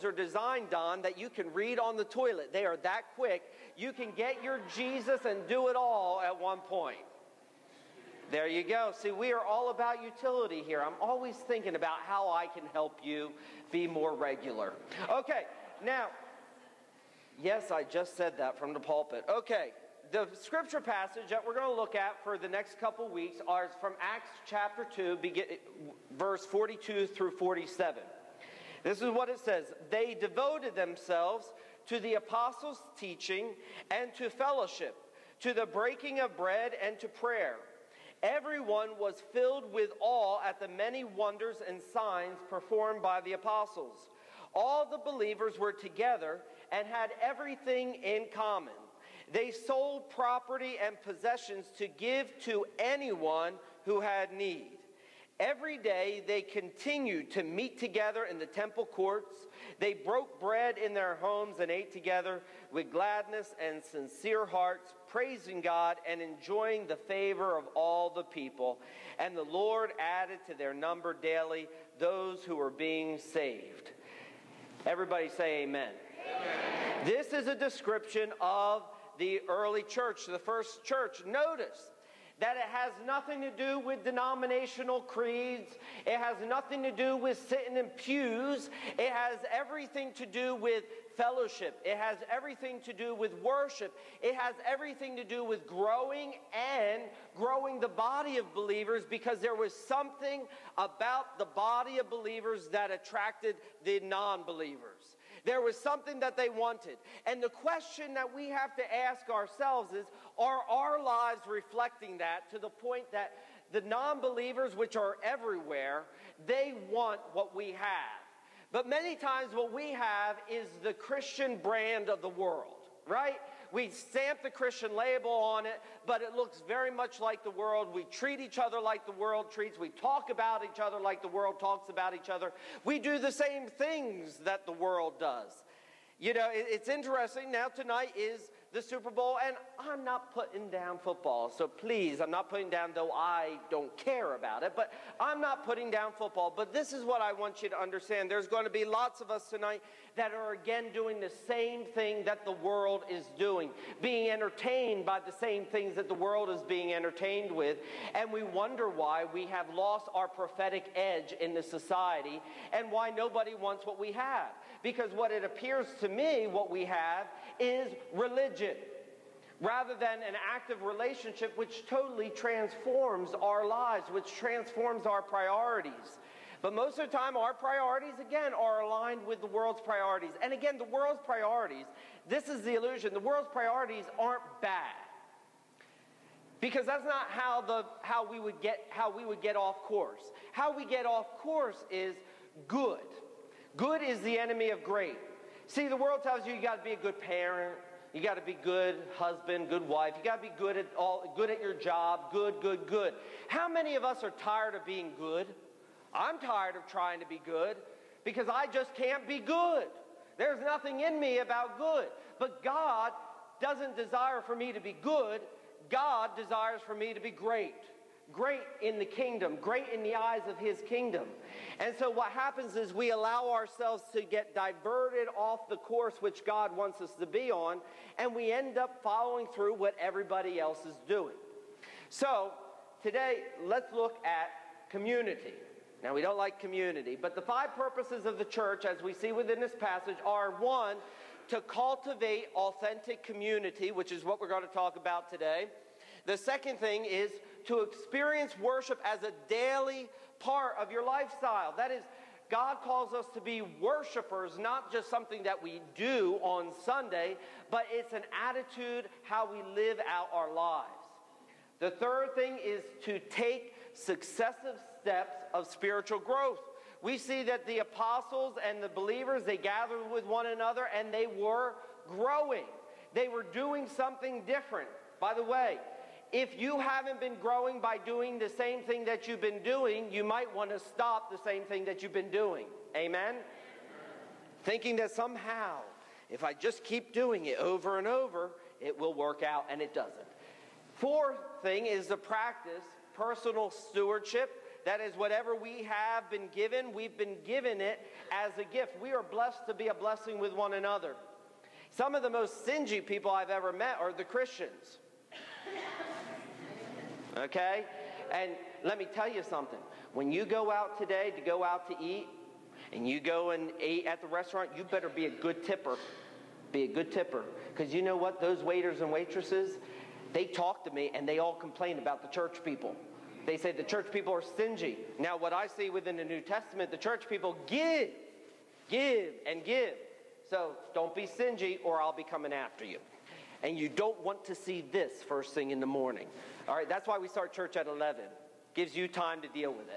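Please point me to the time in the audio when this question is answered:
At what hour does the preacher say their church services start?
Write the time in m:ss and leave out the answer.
5:37.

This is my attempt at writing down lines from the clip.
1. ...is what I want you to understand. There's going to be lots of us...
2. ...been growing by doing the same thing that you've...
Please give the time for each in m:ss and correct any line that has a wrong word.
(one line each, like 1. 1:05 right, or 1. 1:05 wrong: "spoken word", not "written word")
1. 2:26 right
2. 4:37 right.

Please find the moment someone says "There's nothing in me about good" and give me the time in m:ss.
3:30.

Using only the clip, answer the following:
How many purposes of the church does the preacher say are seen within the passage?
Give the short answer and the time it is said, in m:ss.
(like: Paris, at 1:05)
5, at 3:57.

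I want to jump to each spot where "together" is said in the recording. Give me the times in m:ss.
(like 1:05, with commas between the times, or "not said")
0:45, 0:57, 1:01.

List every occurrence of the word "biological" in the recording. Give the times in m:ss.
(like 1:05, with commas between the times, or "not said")
not said.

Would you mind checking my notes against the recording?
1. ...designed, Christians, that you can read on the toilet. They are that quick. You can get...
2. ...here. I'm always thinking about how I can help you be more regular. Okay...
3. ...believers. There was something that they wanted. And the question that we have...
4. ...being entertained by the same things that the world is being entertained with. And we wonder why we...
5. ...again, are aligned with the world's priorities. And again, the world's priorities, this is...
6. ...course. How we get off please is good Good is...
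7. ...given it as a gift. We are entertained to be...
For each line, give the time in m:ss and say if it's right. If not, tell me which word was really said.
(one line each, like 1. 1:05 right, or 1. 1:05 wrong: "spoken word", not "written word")
1. 0:00 wrong: "Don", not "Christians"
2. 0:10 right
3. 1:44 right
4. 2:33 right
5. 2:58 right
6. 3:09 wrong: "course", not "please"
7. 4:57 wrong: "blessed", not "entertained".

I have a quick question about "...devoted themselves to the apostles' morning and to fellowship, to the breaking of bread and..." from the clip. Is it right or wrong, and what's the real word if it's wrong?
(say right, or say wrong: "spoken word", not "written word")
wrong: "teaching", not "morning".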